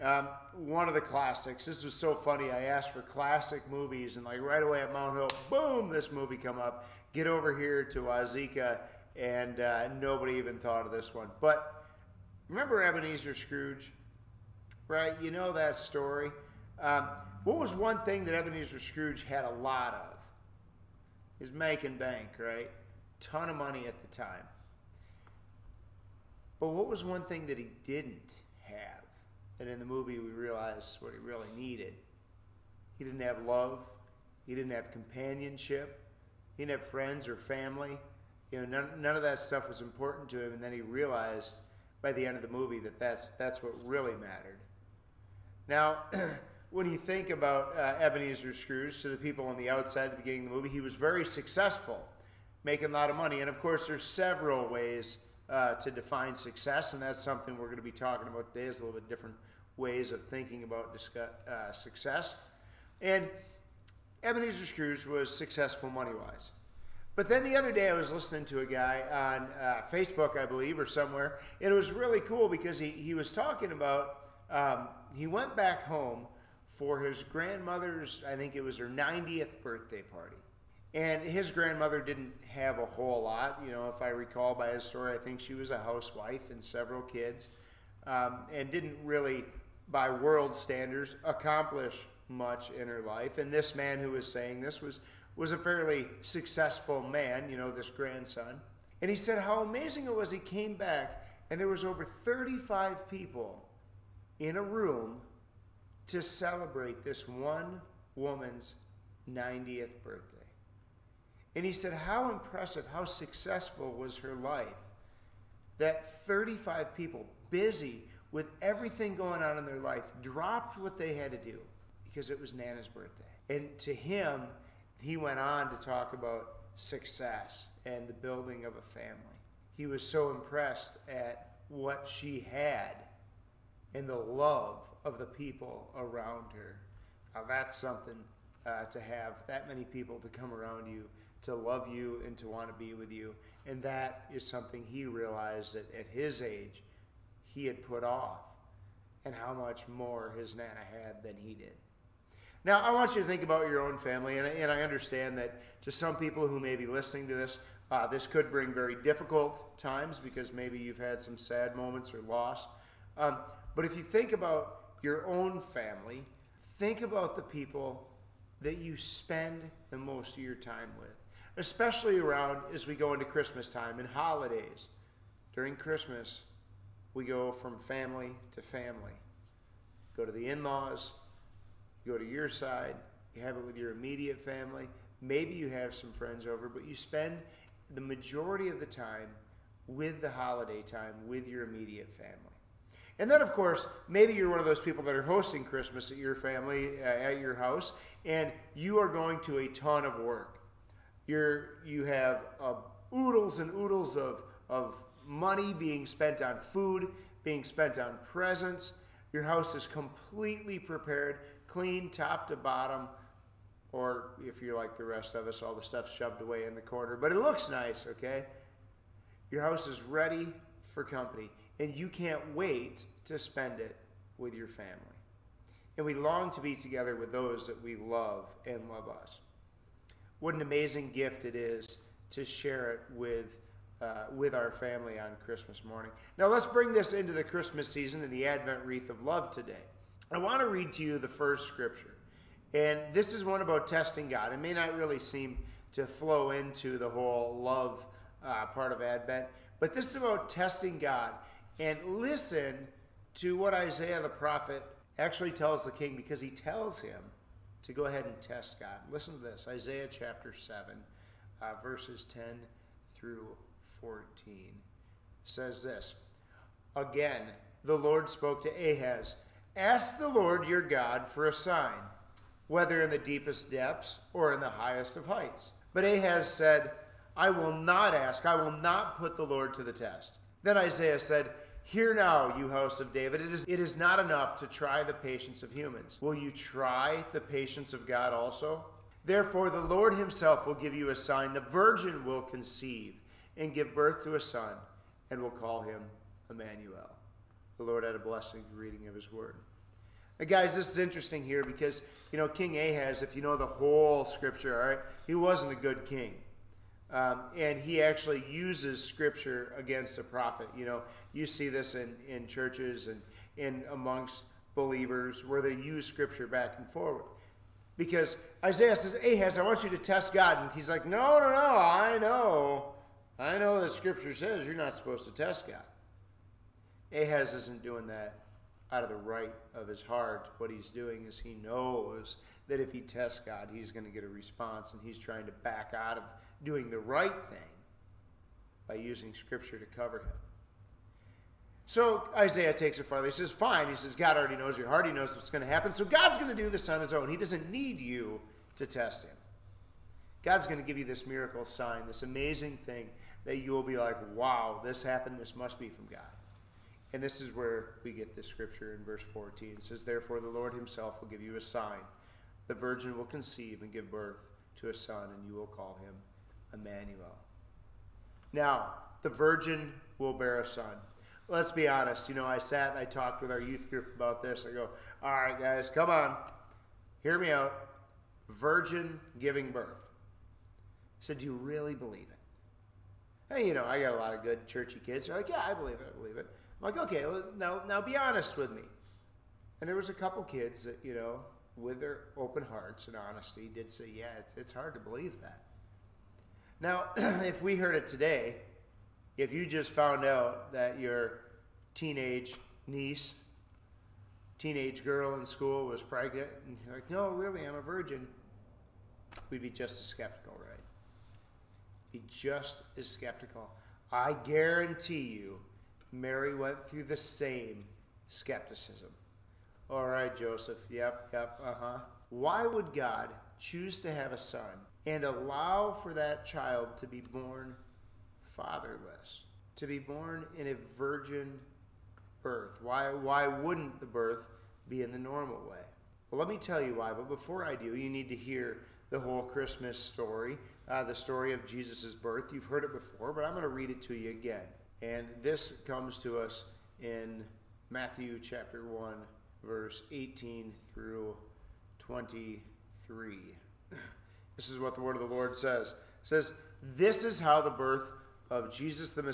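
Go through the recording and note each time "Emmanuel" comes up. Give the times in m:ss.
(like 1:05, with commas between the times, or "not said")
4:56, 6:06.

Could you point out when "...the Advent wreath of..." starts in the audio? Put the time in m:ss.
3:58.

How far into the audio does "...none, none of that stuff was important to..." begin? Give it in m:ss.
0:38.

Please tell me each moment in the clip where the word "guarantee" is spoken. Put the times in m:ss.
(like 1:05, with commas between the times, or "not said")
6:54.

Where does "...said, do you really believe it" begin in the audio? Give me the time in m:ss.
6:21.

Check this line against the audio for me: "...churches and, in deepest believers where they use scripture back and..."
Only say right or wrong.
wrong.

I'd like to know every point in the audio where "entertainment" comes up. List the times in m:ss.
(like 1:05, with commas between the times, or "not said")
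not said.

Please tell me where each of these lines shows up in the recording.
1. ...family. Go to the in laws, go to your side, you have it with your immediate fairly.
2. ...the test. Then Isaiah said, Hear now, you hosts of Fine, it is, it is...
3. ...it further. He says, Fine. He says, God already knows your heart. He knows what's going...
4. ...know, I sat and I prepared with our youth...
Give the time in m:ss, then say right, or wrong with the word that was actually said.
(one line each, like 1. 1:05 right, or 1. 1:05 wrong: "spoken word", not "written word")
1. 2:58 wrong: "family", not "fairly"
2. 4:39 wrong: "David", not "Fine"
3. 5:42 right
4. 6:12 wrong: "talked", not "prepared".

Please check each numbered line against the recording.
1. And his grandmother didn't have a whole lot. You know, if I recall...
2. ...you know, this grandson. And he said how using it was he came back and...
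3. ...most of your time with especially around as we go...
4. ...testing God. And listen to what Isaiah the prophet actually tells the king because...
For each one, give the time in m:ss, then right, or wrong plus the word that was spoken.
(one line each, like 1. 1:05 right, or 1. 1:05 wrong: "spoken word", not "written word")
1. 1:20 right
2. 1:37 wrong: "amazing", not "using"
3. 2:49 right
4. 4:10 right.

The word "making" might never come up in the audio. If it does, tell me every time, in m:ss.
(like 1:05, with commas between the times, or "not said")
0:21, 0:52.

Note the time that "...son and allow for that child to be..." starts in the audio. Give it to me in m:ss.
7:04.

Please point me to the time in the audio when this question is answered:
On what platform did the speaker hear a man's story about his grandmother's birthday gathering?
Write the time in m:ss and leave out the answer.
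1:09.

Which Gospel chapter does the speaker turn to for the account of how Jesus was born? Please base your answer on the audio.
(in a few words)
Matthew chapter 1.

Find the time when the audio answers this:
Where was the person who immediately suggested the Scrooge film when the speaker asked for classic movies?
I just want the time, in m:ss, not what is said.
0:04.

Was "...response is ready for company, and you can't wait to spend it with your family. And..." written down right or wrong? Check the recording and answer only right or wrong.
wrong.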